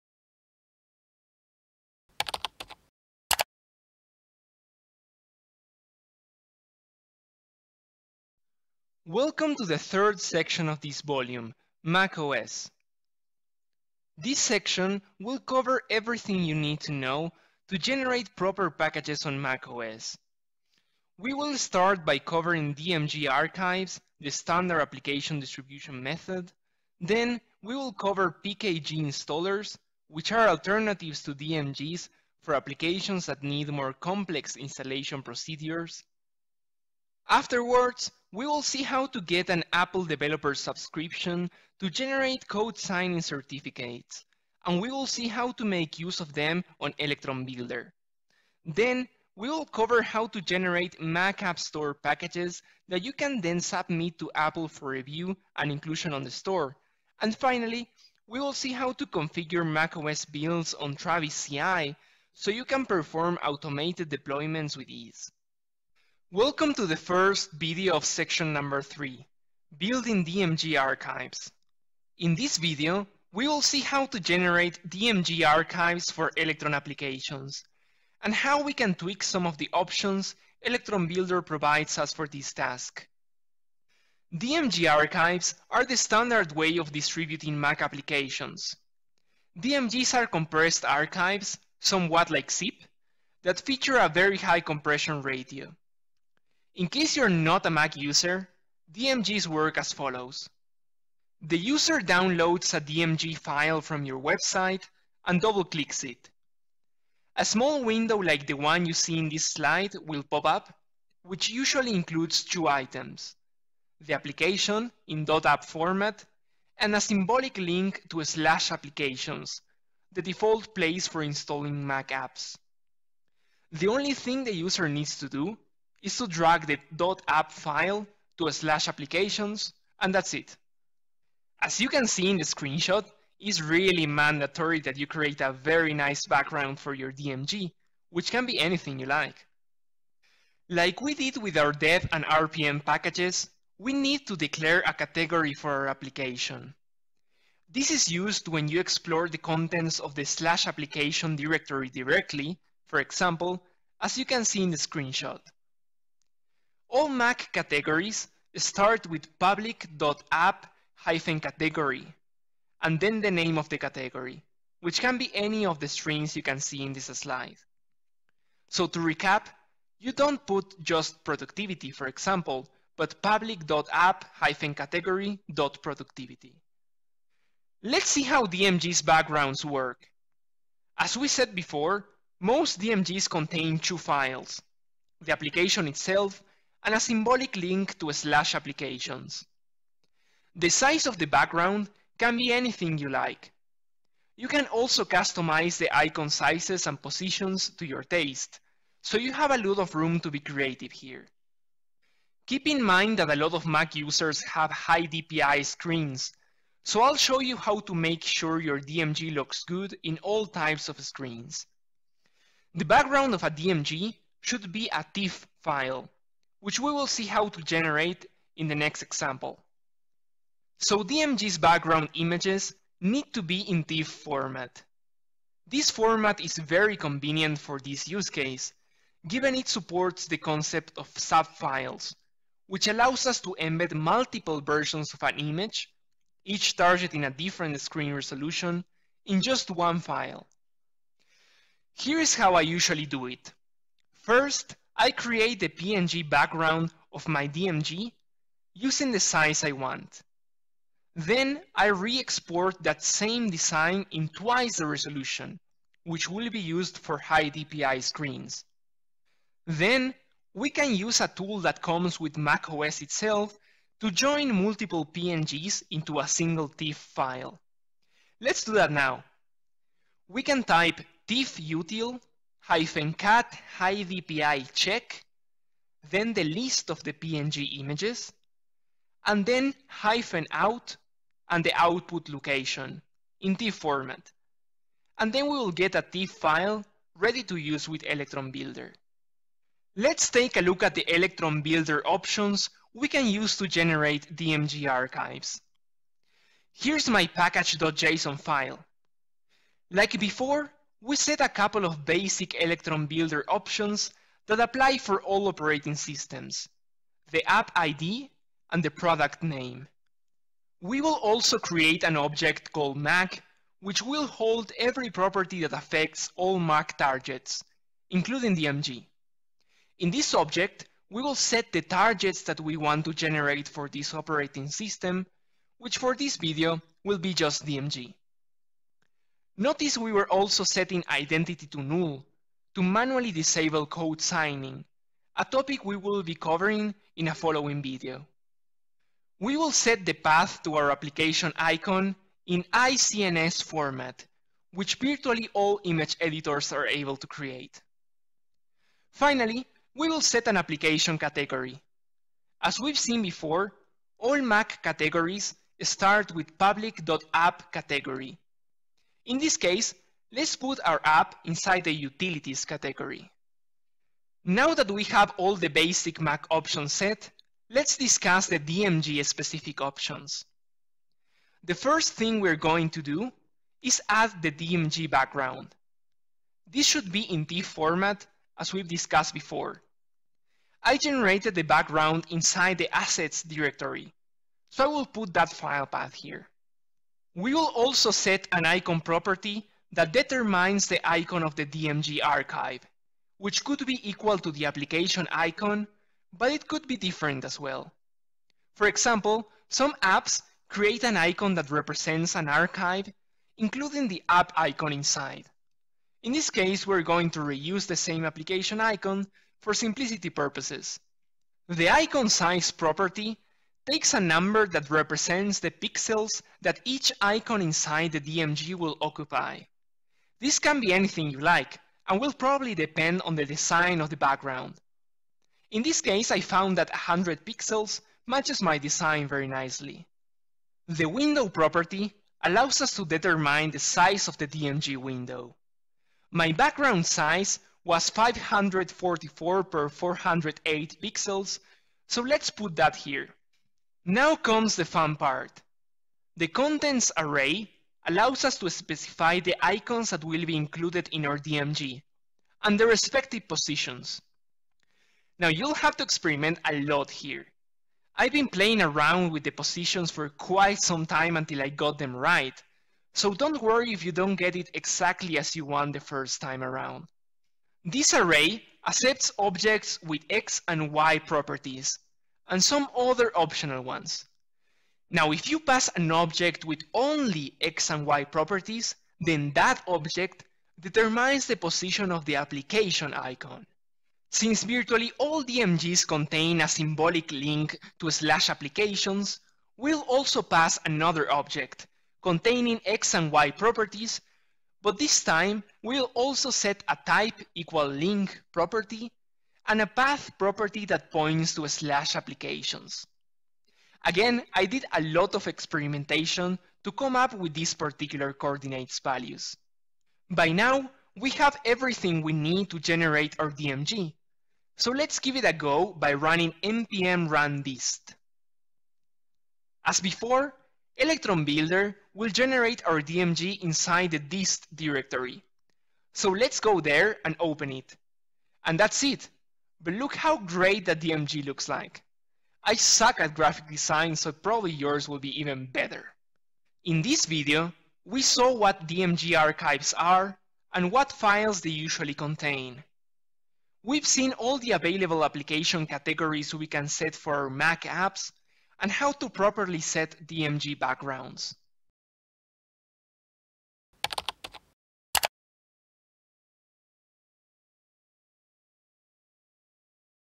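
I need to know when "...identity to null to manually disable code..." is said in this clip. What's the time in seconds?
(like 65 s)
331 s.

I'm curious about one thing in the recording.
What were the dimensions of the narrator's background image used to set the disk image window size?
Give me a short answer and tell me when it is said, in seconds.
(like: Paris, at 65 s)
544 by 408 pixels, at 438 s.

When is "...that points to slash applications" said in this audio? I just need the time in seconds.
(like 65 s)
500 s.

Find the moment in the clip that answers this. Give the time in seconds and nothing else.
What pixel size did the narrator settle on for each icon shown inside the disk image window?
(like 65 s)
426 s.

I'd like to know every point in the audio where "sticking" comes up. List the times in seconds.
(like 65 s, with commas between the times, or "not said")
not said.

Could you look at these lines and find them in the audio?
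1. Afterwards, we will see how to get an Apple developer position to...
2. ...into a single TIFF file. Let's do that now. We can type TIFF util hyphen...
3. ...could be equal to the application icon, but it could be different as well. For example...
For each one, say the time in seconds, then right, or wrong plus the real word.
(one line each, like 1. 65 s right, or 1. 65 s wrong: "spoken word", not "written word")
1. 37 s wrong: "subscription", not "position"
2. 265 s right
3. 393 s right.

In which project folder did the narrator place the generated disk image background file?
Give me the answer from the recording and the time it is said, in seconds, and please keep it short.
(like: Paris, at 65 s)
assets, at 382 s.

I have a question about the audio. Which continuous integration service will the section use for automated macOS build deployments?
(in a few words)
Travis CI.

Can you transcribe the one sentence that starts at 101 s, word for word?
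The user downloads a DMG file from your website and double-clicks it.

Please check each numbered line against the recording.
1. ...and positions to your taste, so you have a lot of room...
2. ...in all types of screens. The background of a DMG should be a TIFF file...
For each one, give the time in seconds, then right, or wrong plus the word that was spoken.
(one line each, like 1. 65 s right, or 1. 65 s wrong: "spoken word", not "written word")
1. 196 s right
2. 210 s right.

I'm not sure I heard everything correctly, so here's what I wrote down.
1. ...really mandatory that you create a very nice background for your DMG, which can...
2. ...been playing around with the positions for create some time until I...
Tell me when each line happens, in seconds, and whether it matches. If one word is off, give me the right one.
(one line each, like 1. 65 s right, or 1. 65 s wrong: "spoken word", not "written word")
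1. 133 s right
2. 458 s wrong: "quite", not "create".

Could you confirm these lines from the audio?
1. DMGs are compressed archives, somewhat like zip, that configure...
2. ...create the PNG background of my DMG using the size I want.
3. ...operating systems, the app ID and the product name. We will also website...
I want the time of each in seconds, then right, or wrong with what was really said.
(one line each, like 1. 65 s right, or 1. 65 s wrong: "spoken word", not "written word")
1. 89 s wrong: "feature", not "configure"
2. 245 s right
3. 305 s wrong: "create", not "website".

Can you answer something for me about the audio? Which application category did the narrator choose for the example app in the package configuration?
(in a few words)
utilities.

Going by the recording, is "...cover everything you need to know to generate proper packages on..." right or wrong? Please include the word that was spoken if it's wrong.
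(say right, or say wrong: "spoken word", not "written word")
right.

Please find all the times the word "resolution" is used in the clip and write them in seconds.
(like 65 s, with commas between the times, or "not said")
238 s, 254 s.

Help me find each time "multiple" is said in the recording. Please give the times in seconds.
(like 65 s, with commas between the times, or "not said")
233 s, 264 s.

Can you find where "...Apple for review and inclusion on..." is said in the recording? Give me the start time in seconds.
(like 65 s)
54 s.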